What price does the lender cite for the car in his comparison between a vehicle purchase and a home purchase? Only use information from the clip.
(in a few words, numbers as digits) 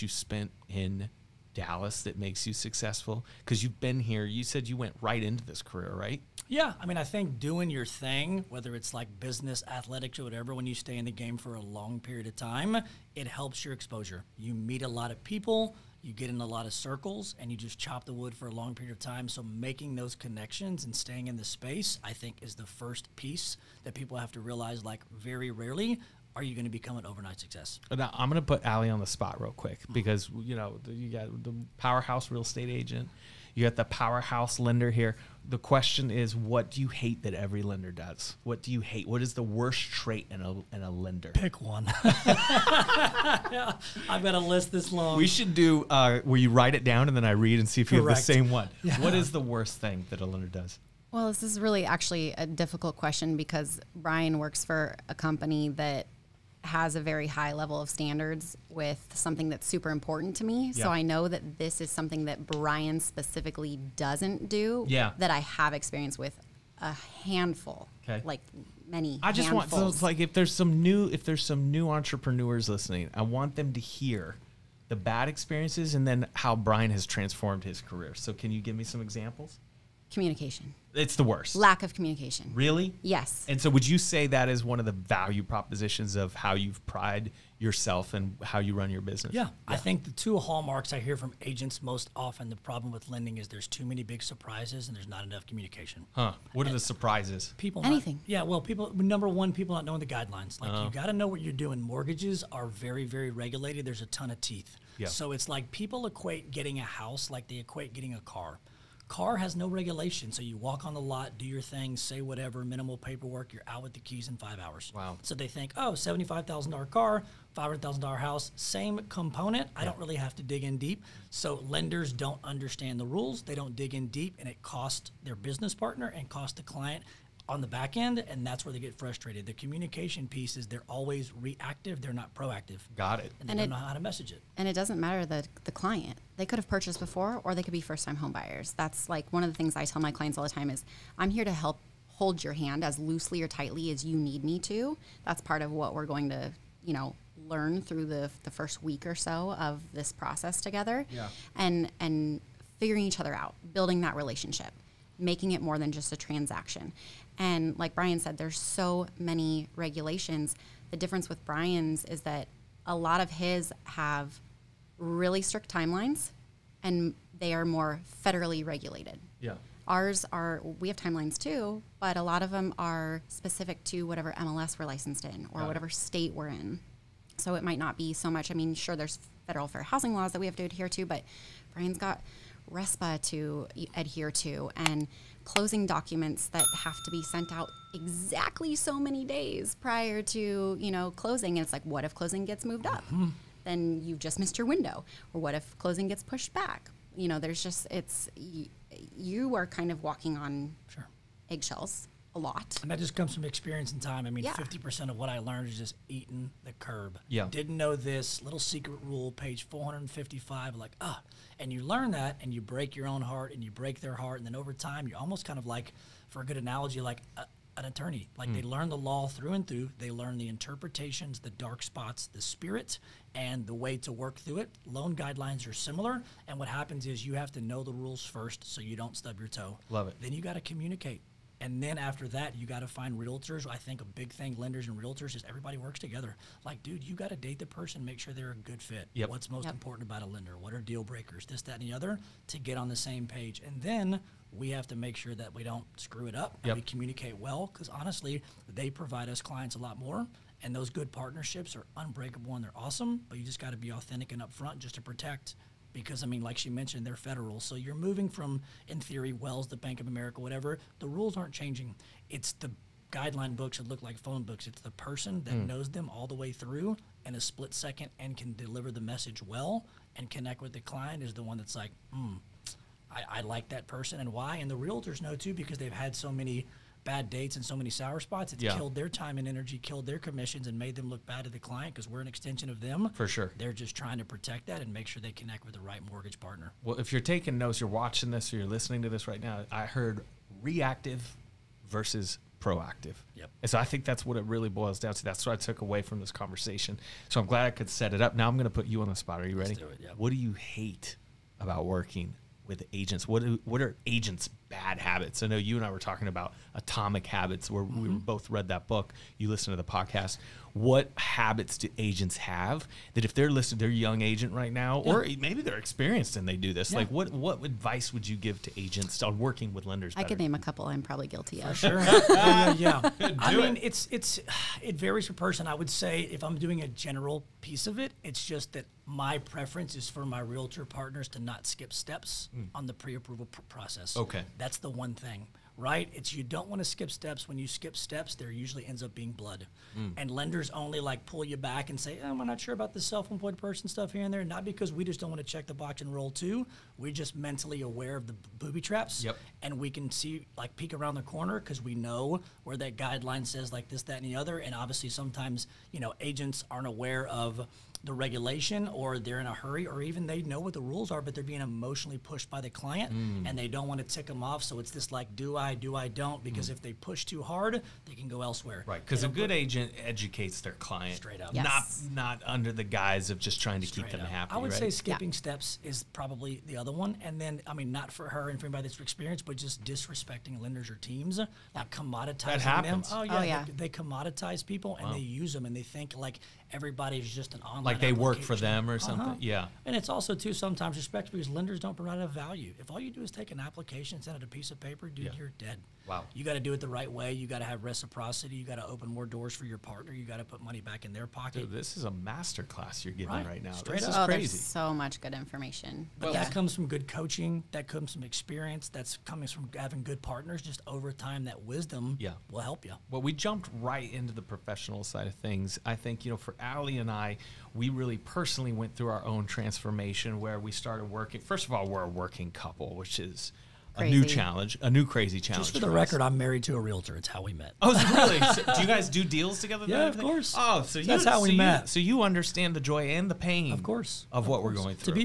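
$75,000.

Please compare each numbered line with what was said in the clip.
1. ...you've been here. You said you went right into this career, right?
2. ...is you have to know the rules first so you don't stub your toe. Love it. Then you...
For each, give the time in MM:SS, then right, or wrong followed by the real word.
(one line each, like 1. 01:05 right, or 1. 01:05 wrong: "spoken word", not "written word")
1. 00:03 right
2. 03:47 right.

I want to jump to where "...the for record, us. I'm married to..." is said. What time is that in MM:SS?
07:05.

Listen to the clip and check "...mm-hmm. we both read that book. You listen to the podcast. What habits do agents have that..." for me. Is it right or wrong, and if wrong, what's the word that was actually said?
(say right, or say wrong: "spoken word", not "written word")
right.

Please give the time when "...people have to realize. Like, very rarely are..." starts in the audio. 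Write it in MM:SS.
00:23.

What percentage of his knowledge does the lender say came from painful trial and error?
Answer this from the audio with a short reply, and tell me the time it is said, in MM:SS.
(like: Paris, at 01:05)
50%, at 03:24.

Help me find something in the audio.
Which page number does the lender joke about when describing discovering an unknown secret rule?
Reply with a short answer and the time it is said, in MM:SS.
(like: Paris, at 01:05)
455, at 03:29.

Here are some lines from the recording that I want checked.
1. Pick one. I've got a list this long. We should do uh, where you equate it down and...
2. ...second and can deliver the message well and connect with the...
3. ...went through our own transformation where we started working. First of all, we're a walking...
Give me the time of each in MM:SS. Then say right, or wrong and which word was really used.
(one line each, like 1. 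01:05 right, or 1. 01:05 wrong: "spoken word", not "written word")
1. 00:41 wrong: "write", not "equate"
2. 04:27 right
3. 06:58 wrong: "working", not "walking".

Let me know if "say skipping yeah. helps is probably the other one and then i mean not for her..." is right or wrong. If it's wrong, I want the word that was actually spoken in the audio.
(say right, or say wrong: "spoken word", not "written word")
wrong: "steps", not "helps".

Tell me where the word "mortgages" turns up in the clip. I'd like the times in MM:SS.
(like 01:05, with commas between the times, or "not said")
01:41, 04:46.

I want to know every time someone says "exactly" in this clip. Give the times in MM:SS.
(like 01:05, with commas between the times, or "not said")
03:07.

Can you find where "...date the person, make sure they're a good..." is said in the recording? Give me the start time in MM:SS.
03:57.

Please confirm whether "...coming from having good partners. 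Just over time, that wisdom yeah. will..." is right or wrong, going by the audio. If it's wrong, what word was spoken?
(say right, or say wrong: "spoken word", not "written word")
right.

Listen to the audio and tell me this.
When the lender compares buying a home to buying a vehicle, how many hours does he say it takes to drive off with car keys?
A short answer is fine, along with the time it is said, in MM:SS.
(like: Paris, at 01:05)
5, at 01:54.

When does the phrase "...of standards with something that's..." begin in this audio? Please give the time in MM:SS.
00:57.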